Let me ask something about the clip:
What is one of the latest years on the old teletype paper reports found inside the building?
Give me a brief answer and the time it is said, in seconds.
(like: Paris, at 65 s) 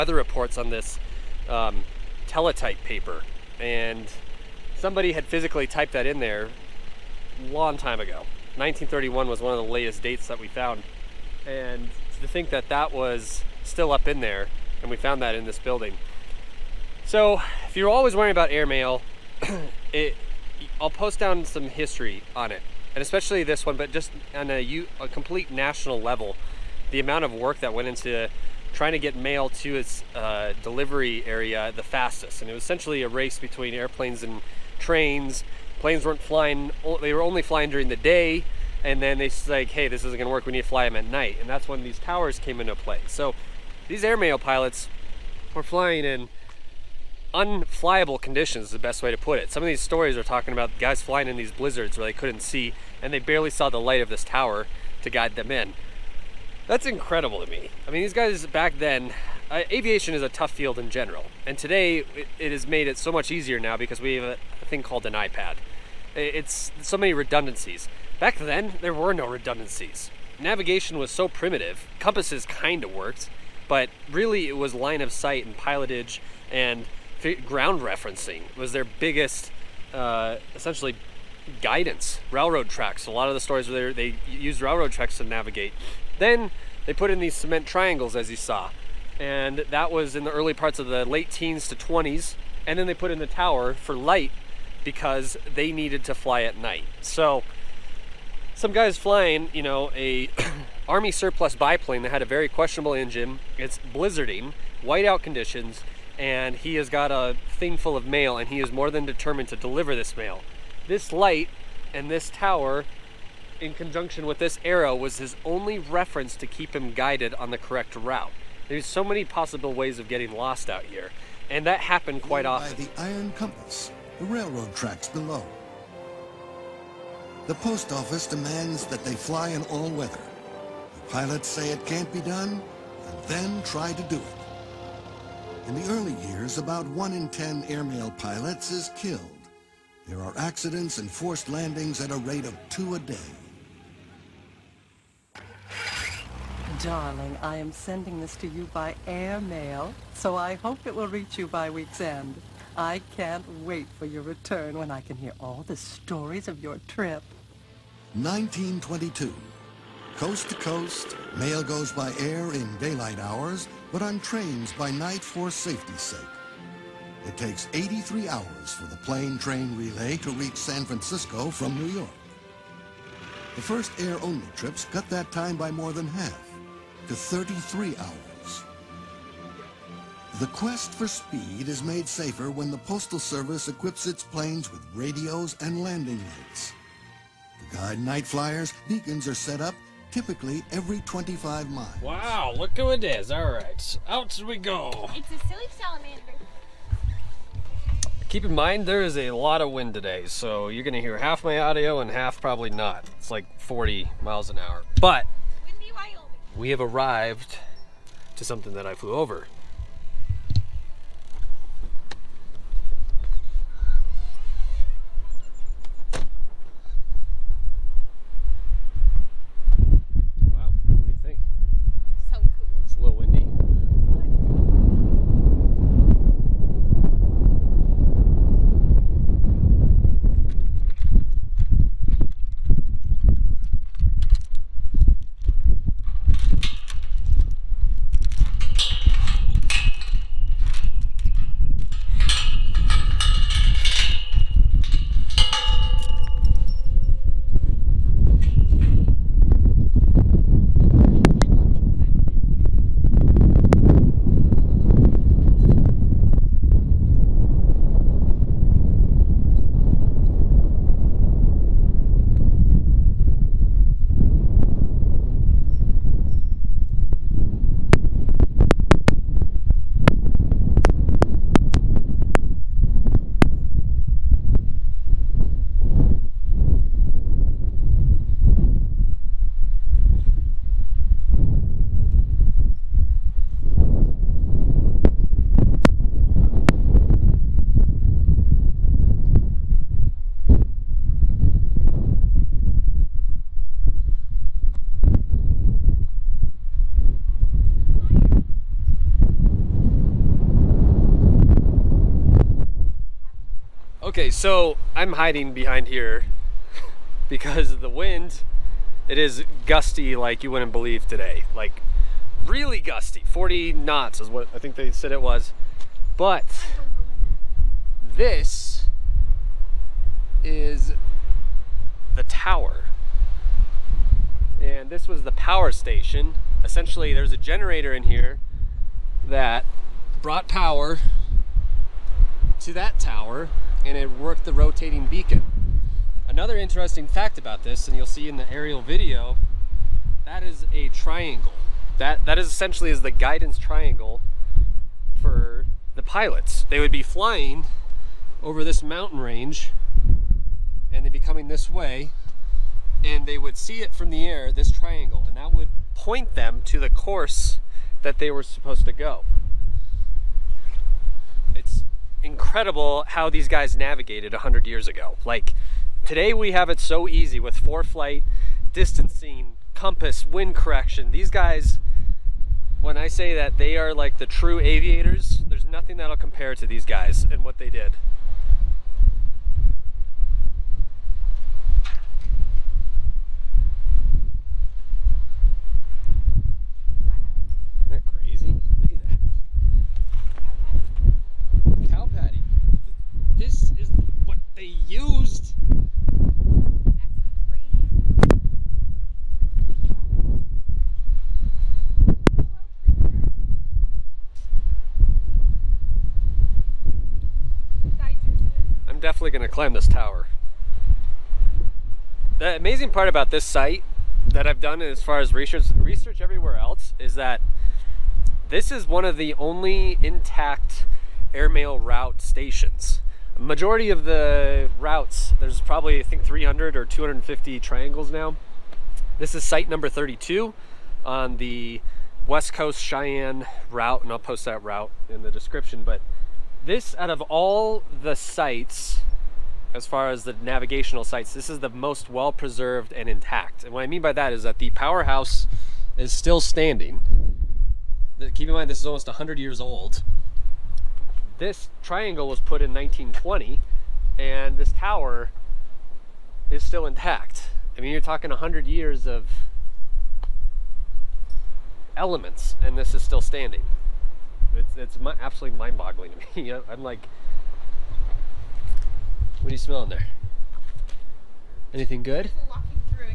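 1931, at 8 s.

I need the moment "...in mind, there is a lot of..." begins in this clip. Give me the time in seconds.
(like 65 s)
198 s.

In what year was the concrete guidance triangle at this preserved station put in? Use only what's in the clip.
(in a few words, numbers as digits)
1920.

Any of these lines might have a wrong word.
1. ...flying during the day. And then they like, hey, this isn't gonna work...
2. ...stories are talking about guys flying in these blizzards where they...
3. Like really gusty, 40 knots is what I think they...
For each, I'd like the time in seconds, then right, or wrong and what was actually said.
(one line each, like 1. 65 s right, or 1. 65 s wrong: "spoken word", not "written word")
1. 37 s right
2. 49 s right
3. 311 s right.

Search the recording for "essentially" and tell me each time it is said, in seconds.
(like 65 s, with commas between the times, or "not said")
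32 s, 80 s, 326 s, 342 s.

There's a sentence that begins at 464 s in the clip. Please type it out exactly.
It's it's absolutely mind-boggling to me.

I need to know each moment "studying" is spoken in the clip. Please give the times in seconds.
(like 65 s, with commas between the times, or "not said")
not said.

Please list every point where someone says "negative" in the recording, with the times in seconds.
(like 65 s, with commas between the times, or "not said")
not said.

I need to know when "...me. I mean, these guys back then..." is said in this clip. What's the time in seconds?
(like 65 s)
57 s.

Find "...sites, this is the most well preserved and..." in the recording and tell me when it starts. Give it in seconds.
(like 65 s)
441 s.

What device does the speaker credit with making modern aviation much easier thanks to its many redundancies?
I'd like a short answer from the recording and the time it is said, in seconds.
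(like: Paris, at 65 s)
iPad, at 65 s.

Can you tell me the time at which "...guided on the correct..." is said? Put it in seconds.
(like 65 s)
116 s.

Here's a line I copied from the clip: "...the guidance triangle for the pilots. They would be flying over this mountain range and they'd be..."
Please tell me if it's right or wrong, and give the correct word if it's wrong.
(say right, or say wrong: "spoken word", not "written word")
right.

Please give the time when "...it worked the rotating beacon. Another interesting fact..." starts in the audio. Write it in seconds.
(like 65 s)
333 s.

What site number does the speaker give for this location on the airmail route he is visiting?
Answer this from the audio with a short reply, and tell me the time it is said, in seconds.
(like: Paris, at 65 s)
32, at 429 s.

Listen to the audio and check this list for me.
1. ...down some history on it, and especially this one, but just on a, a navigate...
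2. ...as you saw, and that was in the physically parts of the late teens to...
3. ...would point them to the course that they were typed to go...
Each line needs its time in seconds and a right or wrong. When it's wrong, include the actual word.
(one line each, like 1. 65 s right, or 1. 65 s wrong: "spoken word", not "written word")
1. 21 s wrong: "complete", not "navigate"
2. 88 s wrong: "early", not "physically"
3. 355 s wrong: "supposed", not "typed".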